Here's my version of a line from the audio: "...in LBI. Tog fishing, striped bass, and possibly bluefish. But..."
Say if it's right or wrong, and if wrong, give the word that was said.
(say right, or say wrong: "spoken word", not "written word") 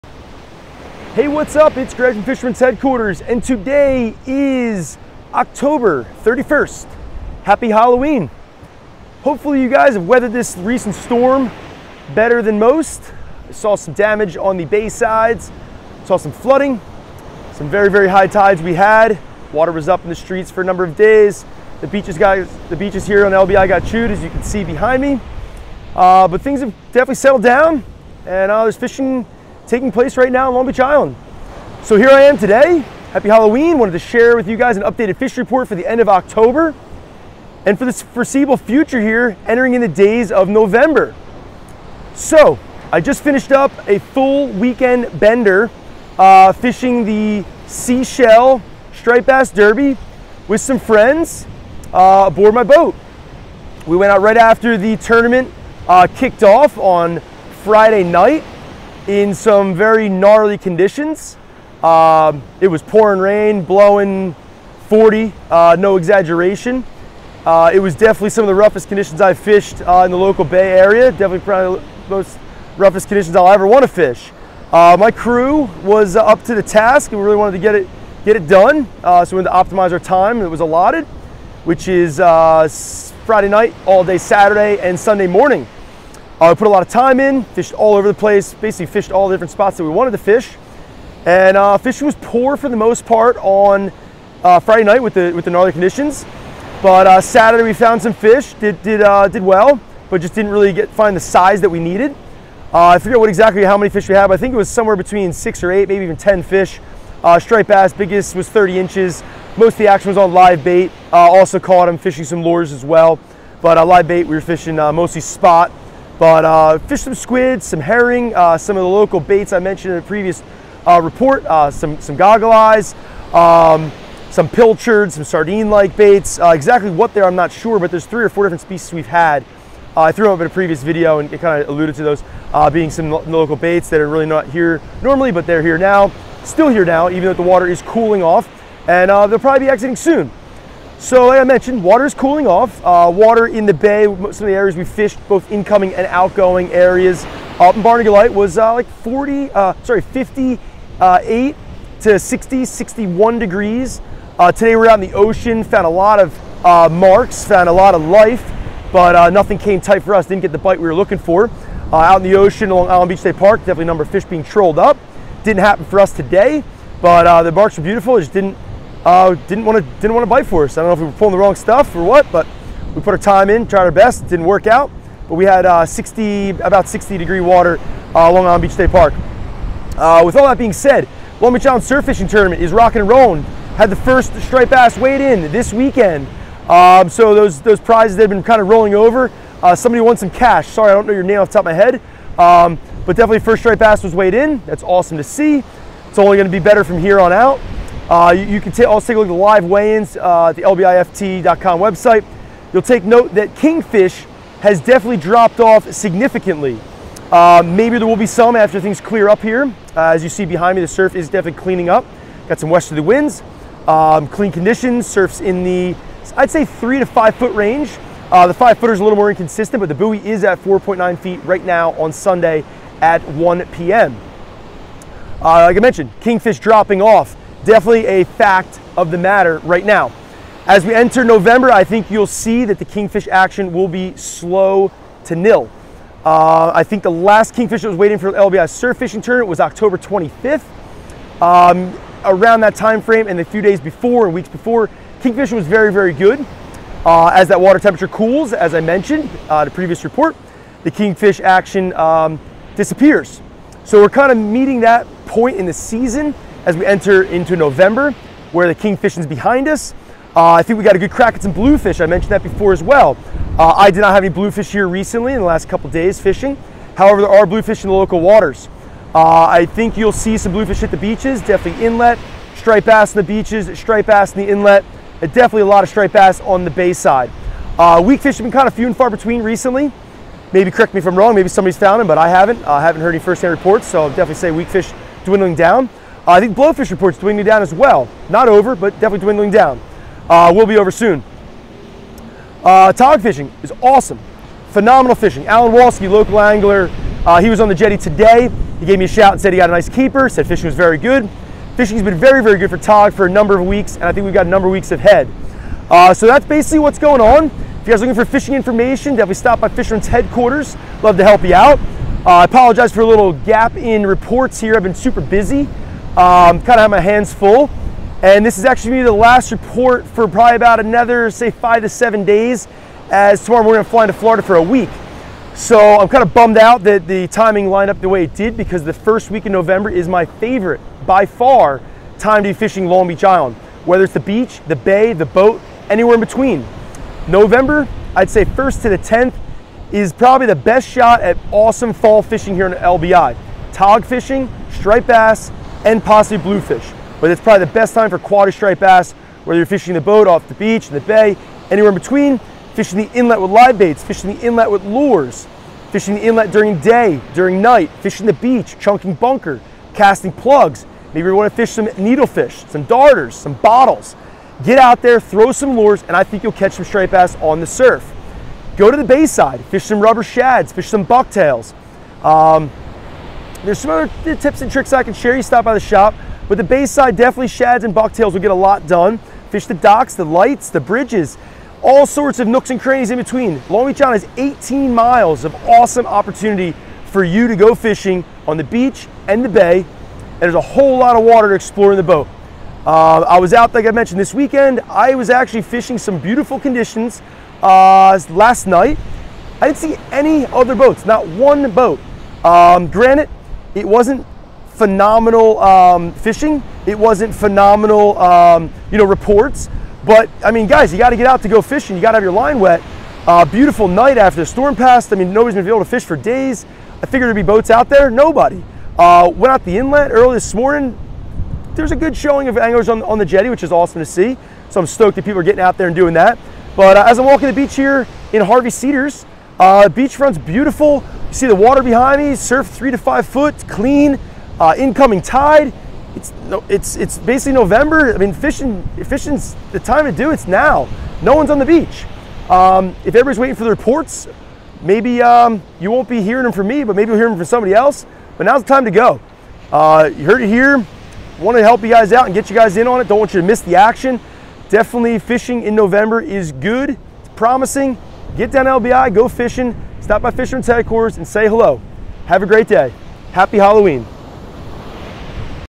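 right.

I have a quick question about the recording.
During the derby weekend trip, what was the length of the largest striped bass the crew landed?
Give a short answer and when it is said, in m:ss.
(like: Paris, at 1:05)
30 inches, at 1:48.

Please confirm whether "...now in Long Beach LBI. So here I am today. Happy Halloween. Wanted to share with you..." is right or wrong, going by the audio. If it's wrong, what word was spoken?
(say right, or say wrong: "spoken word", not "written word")
wrong: "Island", not "LBI".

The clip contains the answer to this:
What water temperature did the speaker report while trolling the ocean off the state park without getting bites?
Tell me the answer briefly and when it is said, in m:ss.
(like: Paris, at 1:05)
60 degrees, at 2:56.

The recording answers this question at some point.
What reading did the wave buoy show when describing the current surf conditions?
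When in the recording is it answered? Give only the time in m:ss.
3:40.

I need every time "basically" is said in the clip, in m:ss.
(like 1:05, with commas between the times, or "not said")
1:28, 5:06, 7:17.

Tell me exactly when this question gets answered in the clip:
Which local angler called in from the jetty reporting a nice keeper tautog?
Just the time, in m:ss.
4:55.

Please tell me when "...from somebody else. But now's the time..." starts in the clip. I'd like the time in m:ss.
7:27.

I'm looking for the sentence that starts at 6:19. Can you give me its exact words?
Fish the docks, the lights, the bridges, all sorts of nooks and crannies in between.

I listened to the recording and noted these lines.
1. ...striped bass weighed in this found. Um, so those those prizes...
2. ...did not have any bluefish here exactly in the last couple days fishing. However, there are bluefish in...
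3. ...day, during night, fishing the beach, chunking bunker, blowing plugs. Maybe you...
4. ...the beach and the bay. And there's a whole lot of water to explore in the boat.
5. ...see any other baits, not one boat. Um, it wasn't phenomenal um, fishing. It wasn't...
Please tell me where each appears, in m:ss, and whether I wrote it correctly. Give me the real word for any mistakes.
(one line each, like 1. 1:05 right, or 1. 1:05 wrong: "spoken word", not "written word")
1. 3:04 wrong: "weekend", not "found"
2. 4:23 wrong: "recently", not "exactly"
3. 5:56 wrong: "casting", not "blowing"
4. 6:28 right
5. 6:39 wrong: "boats", not "baits".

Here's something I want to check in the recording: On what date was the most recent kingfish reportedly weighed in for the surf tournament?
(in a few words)
October 25th.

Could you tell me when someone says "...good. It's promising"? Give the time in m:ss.
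7:36.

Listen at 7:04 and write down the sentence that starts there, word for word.
So I'm stoked that people are getting out there and doing that.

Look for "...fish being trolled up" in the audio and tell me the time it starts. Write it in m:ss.
2:44.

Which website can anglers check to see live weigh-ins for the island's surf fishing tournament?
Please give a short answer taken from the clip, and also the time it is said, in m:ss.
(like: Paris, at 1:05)
lbift.com, at 3:20.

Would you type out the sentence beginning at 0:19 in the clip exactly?
Water was up in the streets for a number of days.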